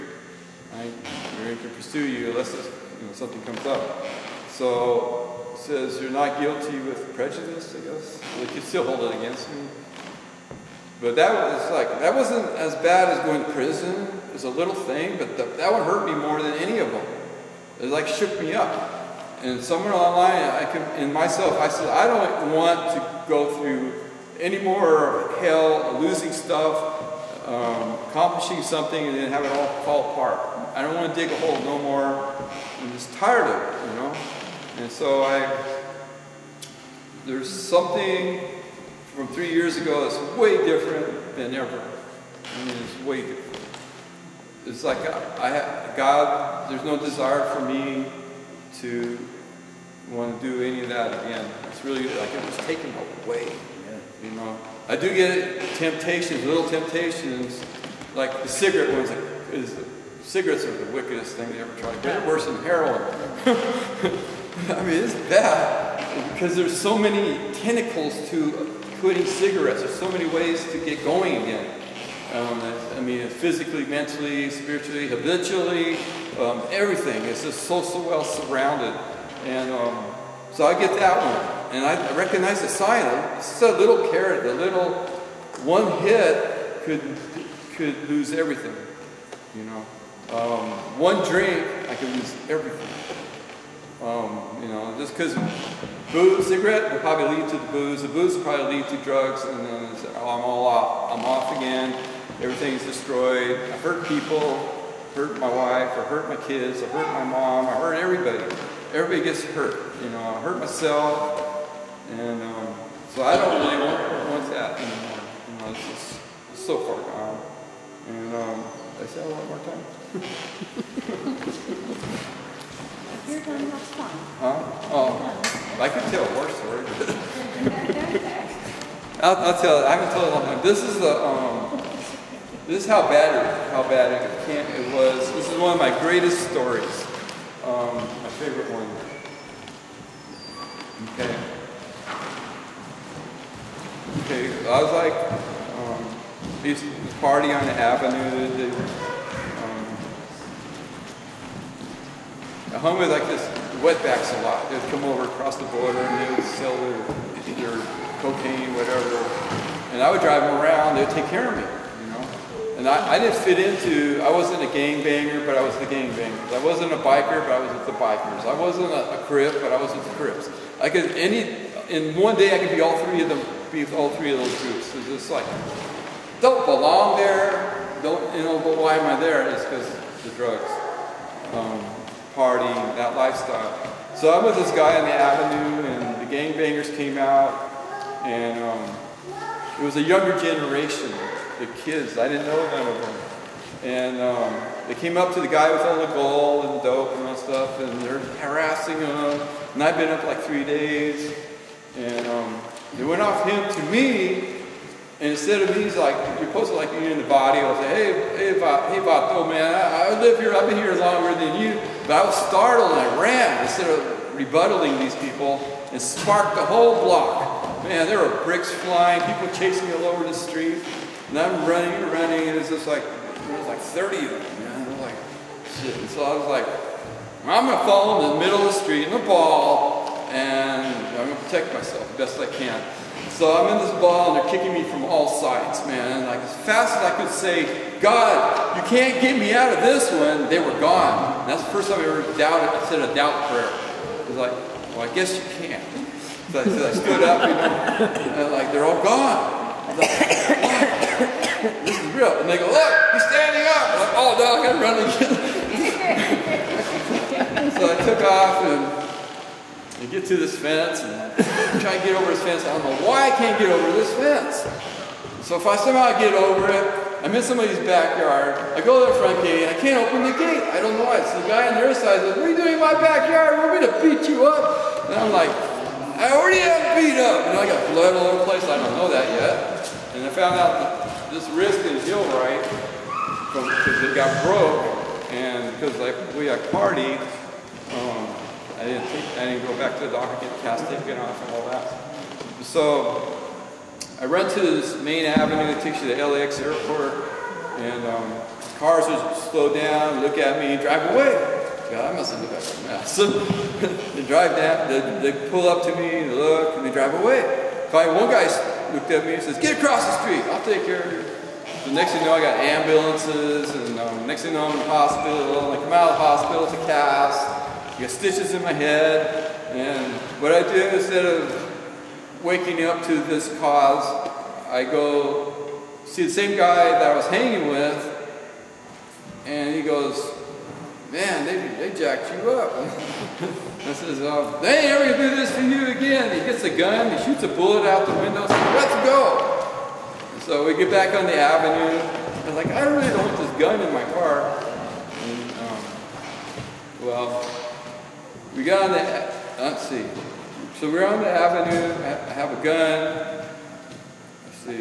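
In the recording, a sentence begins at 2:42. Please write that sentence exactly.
And I, I didn't fit into, I wasn't a gangbanger, but I was the gangbangers.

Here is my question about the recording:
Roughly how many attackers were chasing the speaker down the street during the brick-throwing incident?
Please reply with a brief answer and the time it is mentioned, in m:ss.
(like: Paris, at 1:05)
30, at 3:43.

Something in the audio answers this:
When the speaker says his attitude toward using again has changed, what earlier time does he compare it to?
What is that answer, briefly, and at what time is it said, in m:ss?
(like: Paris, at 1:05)
three years ago, at 0:39.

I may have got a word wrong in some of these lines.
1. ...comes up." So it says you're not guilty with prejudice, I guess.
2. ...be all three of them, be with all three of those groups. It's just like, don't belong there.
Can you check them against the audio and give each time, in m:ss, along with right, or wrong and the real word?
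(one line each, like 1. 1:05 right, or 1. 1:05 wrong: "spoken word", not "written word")
1. 0:03 right
2. 2:52 right.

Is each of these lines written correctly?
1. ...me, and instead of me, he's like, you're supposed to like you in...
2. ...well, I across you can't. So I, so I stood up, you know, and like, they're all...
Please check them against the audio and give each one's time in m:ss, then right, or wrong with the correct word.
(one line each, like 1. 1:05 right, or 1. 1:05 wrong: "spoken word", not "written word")
1. 3:23 right
2. 4:04 wrong: "guess", not "across".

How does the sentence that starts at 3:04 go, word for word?
So I'm with this guy on the avenue, and the gangbangers came out, and um, it was a younger generation, the kids.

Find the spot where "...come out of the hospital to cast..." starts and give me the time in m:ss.
5:15.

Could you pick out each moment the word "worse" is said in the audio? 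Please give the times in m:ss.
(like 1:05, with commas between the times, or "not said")
1:02, 2:06.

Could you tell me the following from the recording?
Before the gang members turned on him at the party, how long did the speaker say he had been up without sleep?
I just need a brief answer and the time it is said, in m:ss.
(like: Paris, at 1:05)
3 days, at 3:20.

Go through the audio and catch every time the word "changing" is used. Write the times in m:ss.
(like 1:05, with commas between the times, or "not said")
not said.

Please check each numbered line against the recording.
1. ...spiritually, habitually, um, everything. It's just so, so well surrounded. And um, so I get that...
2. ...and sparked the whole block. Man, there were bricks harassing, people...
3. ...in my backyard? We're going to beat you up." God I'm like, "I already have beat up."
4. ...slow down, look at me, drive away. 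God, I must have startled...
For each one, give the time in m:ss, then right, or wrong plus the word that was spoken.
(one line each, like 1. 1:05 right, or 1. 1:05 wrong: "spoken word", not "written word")
1. 1:14 right
2. 3:35 wrong: "flying", not "harassing"
3. 4:32 wrong: "And", not "God"
4. 4:59 wrong: "looked", not "startled".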